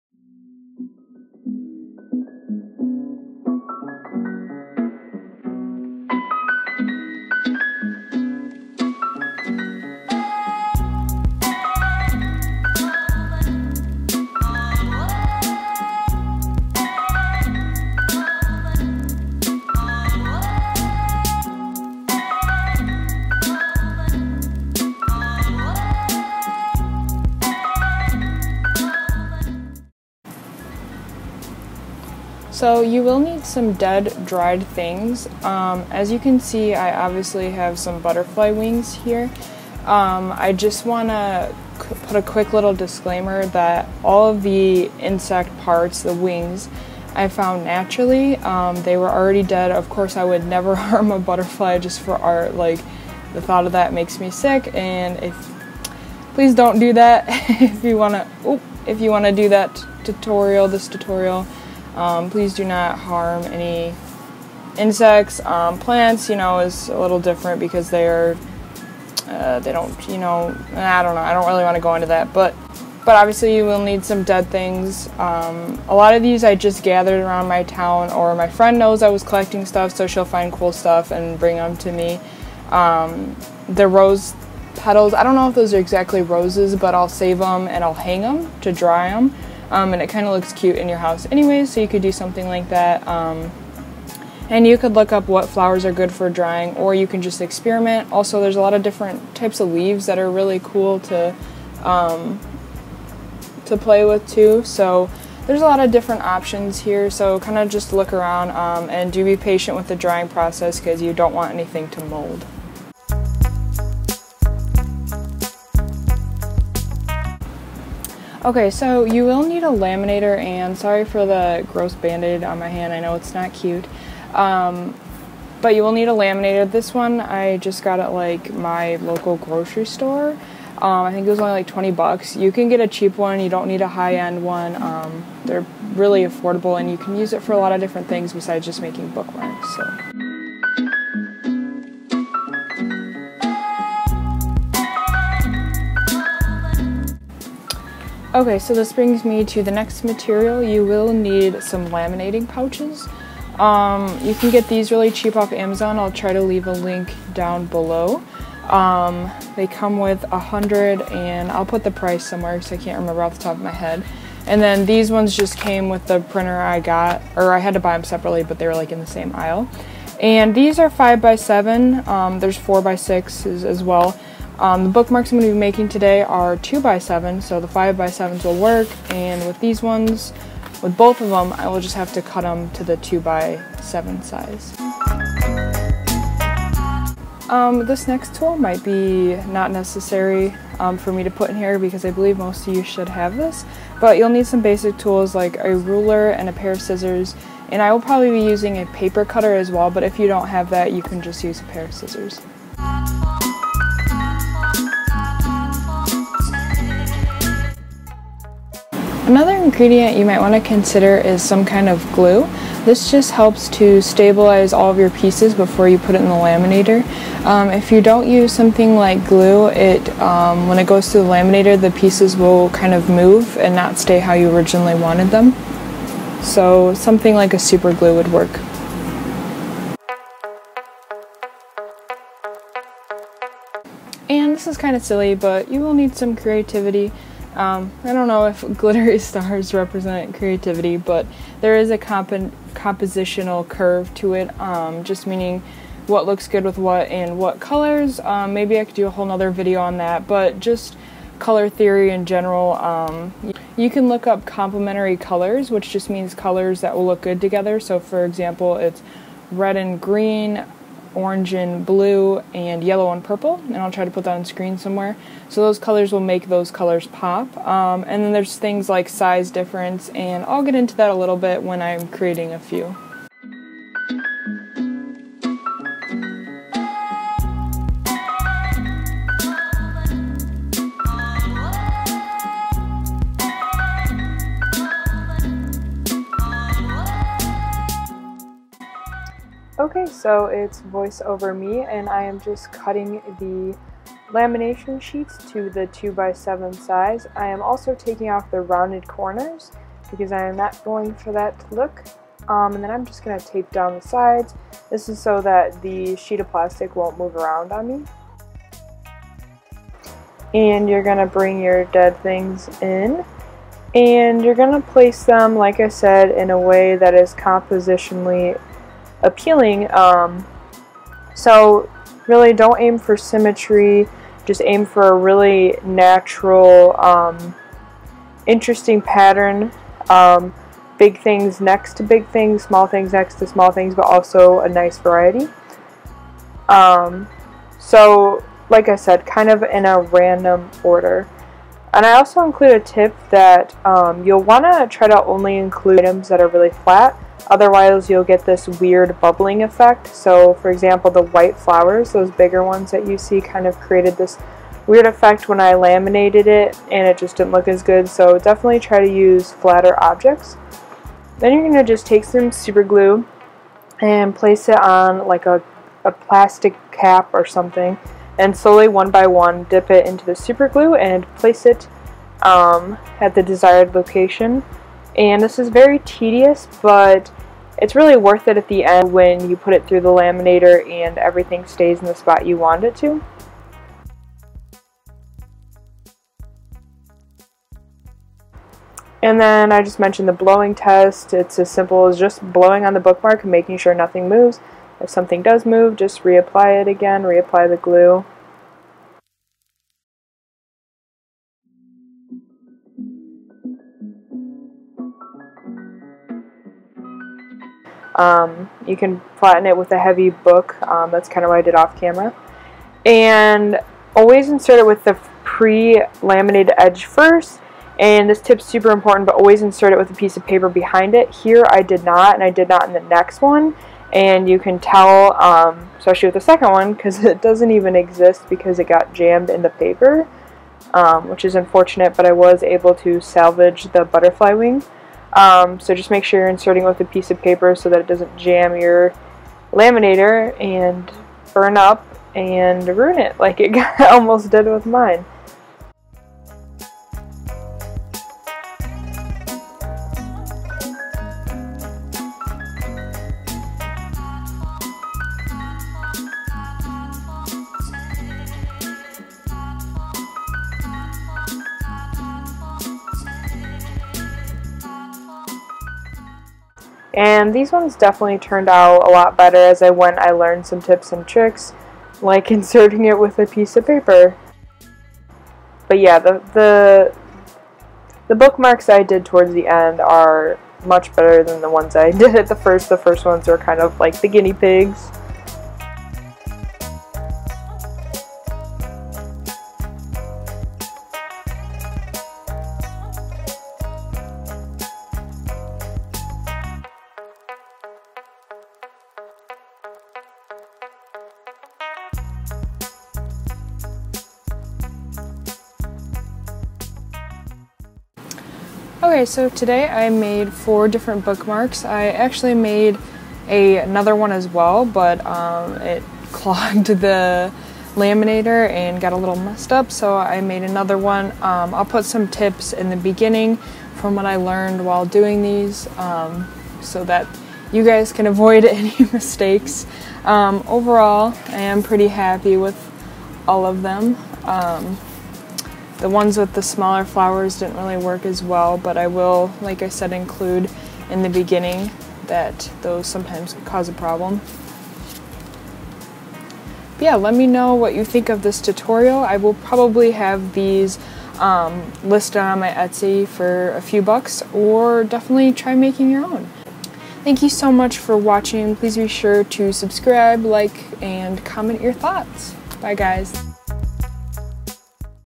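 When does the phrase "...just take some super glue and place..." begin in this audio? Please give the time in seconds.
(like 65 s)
361 s.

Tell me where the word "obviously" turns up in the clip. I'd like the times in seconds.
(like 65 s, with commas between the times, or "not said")
37 s, 73 s.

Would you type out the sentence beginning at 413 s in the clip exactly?
And always insert it with the pre-laminated edge first.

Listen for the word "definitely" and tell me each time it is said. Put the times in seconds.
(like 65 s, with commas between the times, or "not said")
358 s, 467 s, 555 s.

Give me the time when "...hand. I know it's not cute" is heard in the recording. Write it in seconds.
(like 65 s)
122 s.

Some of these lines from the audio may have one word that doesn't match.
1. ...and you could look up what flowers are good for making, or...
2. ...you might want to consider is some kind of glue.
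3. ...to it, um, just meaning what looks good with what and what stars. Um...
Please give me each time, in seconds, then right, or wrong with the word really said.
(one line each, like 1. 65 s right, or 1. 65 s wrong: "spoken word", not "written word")
1. 94 s wrong: "drying", not "making"
2. 210 s right
3. 244 s wrong: "colors", not "stars".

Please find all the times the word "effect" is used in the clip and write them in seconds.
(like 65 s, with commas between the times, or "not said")
349 s, 355 s.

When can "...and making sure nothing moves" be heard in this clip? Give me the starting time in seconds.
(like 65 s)
393 s.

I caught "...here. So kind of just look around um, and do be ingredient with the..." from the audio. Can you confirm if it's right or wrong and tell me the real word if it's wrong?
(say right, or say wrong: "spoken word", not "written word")
wrong: "patient", not "ingredient".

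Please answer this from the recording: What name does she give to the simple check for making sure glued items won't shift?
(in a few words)
blowing test.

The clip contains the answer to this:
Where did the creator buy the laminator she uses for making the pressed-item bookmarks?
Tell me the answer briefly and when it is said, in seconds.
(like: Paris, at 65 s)
local grocery store, at 128 s.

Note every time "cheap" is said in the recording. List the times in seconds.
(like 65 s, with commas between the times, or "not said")
132 s, 155 s.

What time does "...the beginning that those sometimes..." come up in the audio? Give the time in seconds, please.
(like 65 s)
541 s.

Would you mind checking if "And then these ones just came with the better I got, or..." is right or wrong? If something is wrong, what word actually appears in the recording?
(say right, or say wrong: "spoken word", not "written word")
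wrong: "printer", not "better".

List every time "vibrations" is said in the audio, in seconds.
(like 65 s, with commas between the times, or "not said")
not said.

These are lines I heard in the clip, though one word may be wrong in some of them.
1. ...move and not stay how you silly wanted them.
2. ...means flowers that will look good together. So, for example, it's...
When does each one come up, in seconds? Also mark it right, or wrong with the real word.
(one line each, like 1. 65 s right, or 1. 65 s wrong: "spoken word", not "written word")
1. 223 s wrong: "originally", not "silly"
2. 256 s wrong: "colors", not "flowers".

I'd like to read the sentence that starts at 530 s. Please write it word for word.
Um, overall, I am pretty happy with all of them.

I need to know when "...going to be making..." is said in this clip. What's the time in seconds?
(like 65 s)
175 s.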